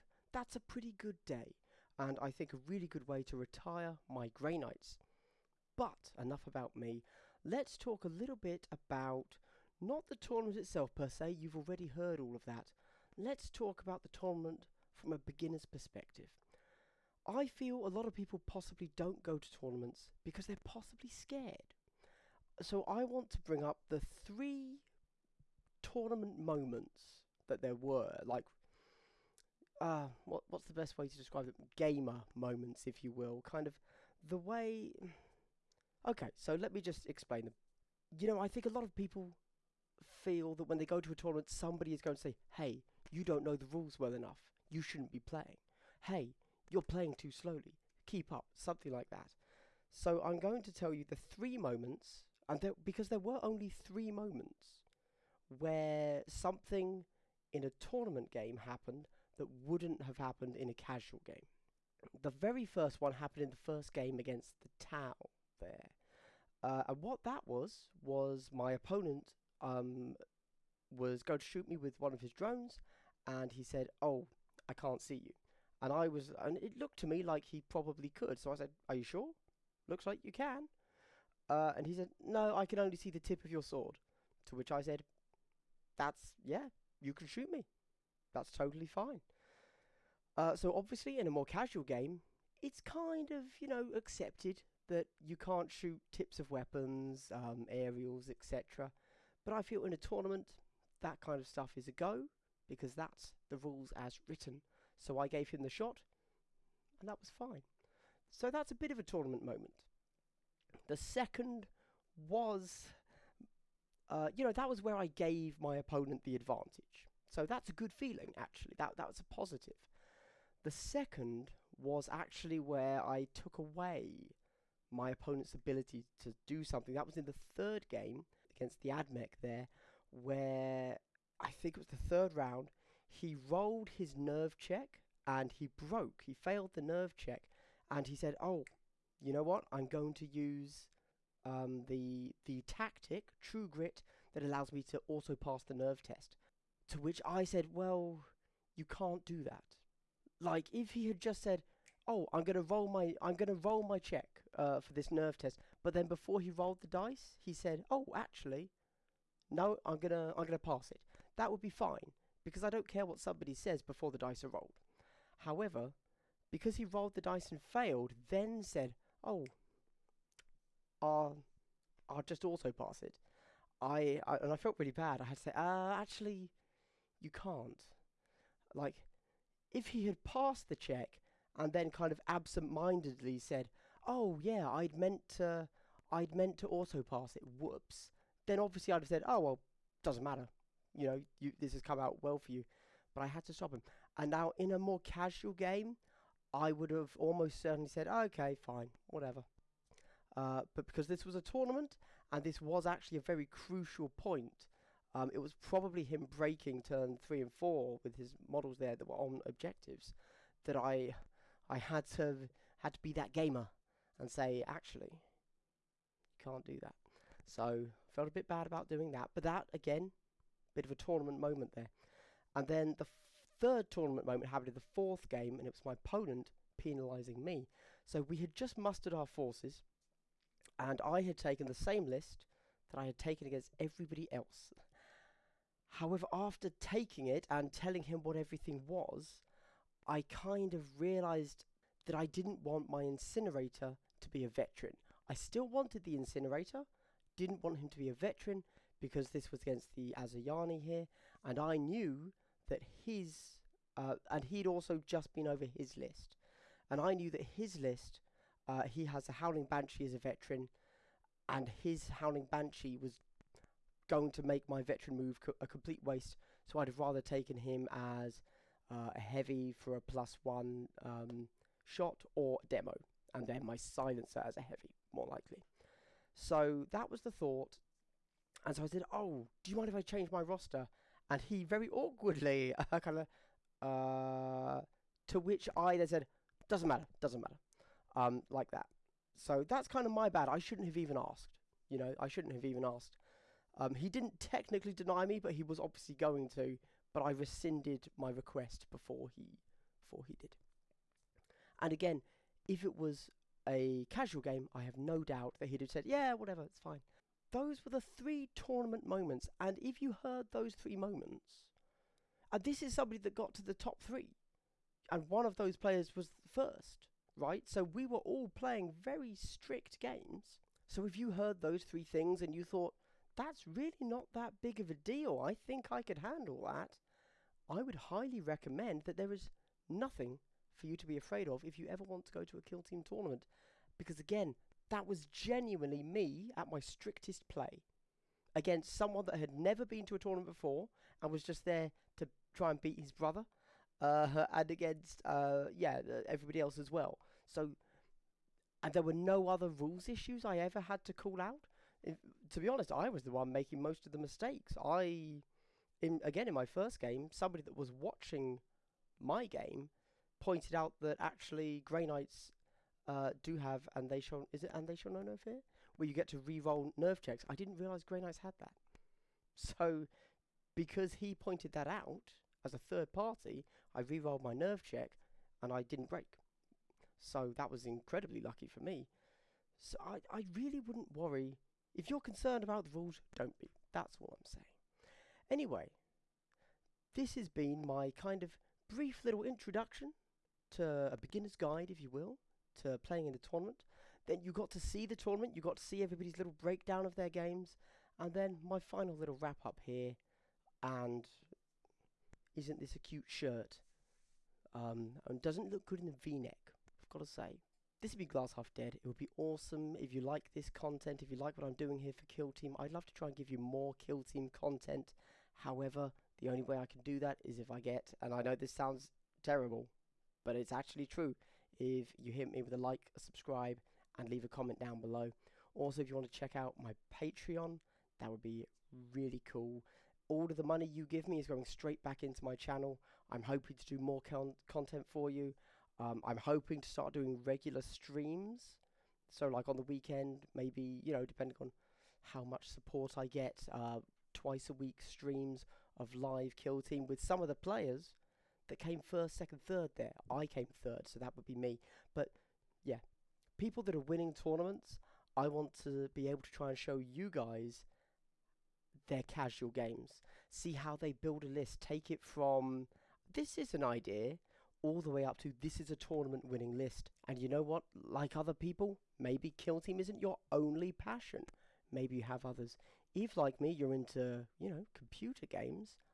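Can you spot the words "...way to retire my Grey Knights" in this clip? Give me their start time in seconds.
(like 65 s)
3 s.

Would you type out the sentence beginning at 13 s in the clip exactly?
Let's talk about the tournament from a beginner's perspective.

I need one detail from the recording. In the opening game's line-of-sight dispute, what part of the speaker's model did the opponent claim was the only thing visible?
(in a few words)
Tip of your sword.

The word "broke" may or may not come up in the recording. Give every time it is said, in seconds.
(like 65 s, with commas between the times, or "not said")
135 s.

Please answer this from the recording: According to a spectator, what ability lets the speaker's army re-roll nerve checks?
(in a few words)
They Shall Know No Fear.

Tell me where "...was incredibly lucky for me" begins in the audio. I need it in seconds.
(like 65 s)
377 s.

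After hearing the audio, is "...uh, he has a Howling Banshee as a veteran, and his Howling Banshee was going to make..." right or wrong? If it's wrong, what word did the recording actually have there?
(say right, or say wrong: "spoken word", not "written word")
right.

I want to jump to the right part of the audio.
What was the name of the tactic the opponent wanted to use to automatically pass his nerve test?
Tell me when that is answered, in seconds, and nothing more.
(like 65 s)
143 s.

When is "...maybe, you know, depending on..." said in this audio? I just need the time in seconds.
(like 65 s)
440 s.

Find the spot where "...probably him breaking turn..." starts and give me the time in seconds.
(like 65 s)
205 s.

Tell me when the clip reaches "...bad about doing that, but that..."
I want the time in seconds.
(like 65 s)
218 s.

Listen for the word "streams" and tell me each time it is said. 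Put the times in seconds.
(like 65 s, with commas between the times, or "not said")
437 s, 445 s.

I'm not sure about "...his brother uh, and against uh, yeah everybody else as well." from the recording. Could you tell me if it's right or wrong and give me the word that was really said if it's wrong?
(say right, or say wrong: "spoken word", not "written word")
right.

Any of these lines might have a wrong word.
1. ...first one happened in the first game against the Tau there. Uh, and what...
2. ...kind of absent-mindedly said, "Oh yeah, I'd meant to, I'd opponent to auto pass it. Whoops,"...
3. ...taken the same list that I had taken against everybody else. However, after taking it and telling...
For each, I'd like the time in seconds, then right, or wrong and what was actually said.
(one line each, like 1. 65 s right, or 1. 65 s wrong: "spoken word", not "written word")
1. 62 s right
2. 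181 s wrong: "meant", not "opponent"
3. 231 s right.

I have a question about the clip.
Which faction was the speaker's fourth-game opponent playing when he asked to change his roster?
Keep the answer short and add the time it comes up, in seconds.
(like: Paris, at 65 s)
Asuryani, at 250 s.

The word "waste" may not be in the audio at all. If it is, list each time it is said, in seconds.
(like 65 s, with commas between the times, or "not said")
266 s.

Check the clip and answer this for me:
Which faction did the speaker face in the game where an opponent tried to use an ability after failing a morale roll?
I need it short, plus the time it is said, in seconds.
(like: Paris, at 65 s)
Admech, at 128 s.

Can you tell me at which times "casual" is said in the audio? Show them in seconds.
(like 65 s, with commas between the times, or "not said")
60 s, 91 s, 194 s, 304 s, 459 s.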